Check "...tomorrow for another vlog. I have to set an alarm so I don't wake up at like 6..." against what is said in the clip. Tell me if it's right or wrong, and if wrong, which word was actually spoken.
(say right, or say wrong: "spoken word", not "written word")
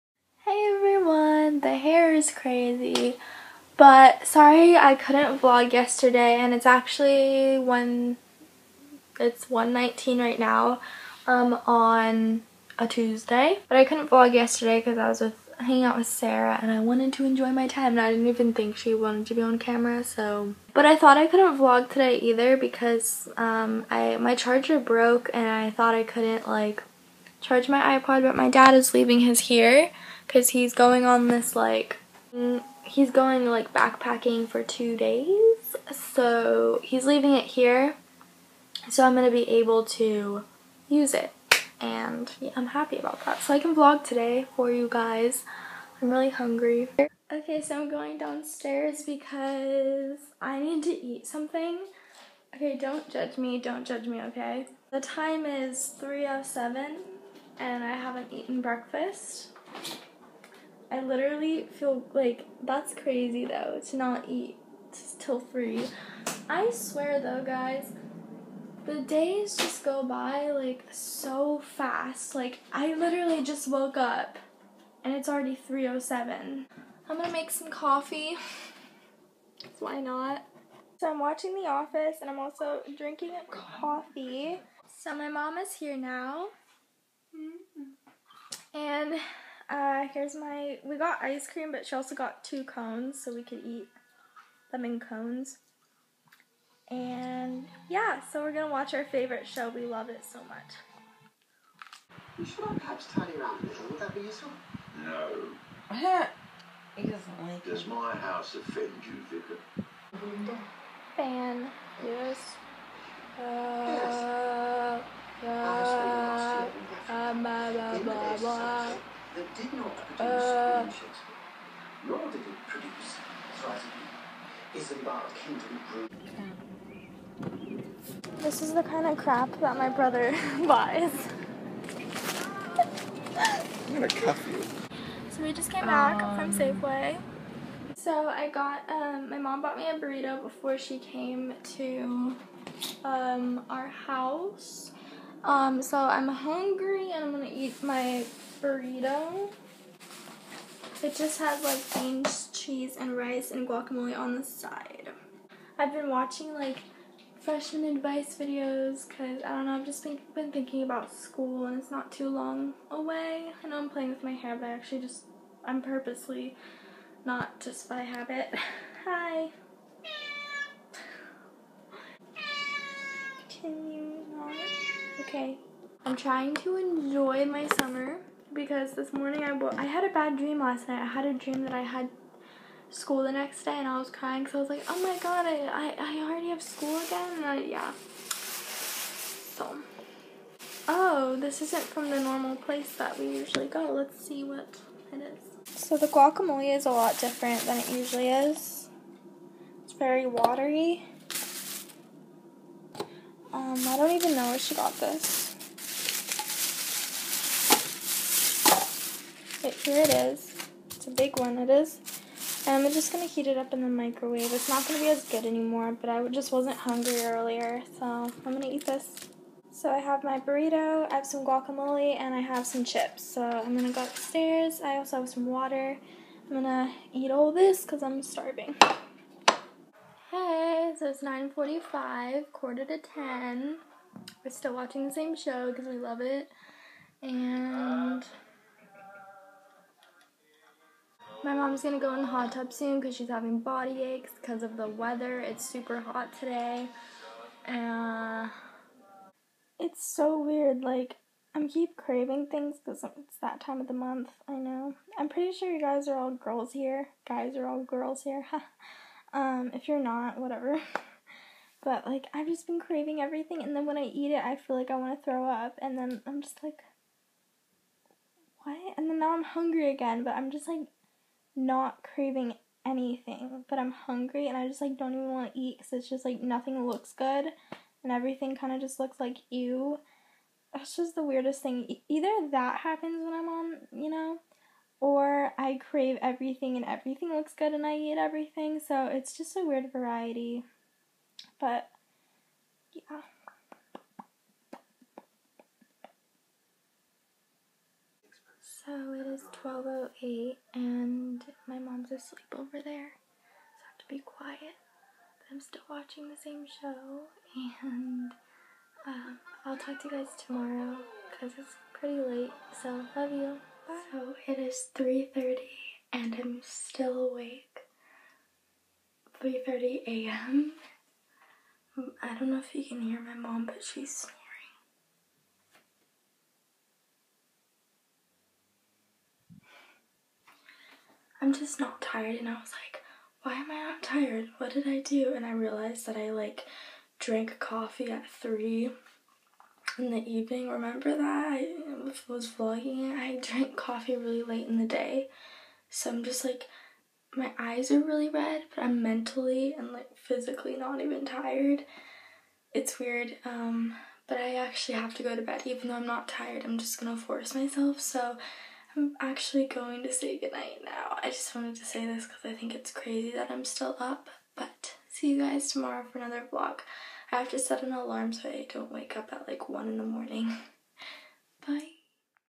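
wrong: "1", not "6".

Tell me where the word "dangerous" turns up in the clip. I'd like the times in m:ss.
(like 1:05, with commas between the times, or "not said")
not said.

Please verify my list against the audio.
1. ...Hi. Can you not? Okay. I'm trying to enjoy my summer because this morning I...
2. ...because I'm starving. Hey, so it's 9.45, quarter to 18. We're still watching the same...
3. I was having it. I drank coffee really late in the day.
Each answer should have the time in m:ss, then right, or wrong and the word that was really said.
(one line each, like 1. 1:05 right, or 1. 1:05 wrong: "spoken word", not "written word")
1. 2:49 right
2. 3:47 wrong: "10", not "18"
3. 5:41 wrong: "vlogging", not "having".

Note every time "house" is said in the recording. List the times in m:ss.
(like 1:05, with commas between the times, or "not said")
1:48, 2:23.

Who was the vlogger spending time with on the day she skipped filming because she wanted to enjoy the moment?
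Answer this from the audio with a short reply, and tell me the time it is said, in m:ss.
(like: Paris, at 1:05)
Sarah, at 0:16.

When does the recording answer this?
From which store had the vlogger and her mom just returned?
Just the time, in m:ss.
2:16.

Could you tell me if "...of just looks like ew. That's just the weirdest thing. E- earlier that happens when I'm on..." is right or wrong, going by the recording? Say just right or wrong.
wrong.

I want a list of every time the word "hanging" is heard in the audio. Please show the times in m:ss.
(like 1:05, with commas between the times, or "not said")
0:15.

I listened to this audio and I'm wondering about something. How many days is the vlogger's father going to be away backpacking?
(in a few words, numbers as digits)
2.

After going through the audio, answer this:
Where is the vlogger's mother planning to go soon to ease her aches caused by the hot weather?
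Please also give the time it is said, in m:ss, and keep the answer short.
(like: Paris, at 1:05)
hot tub, at 4:02.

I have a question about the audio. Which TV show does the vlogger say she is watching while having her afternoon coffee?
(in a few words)
The Office.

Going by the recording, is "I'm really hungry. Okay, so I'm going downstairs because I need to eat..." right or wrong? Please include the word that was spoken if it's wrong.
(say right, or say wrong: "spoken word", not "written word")
right.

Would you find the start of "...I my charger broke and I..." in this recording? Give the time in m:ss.
0:23.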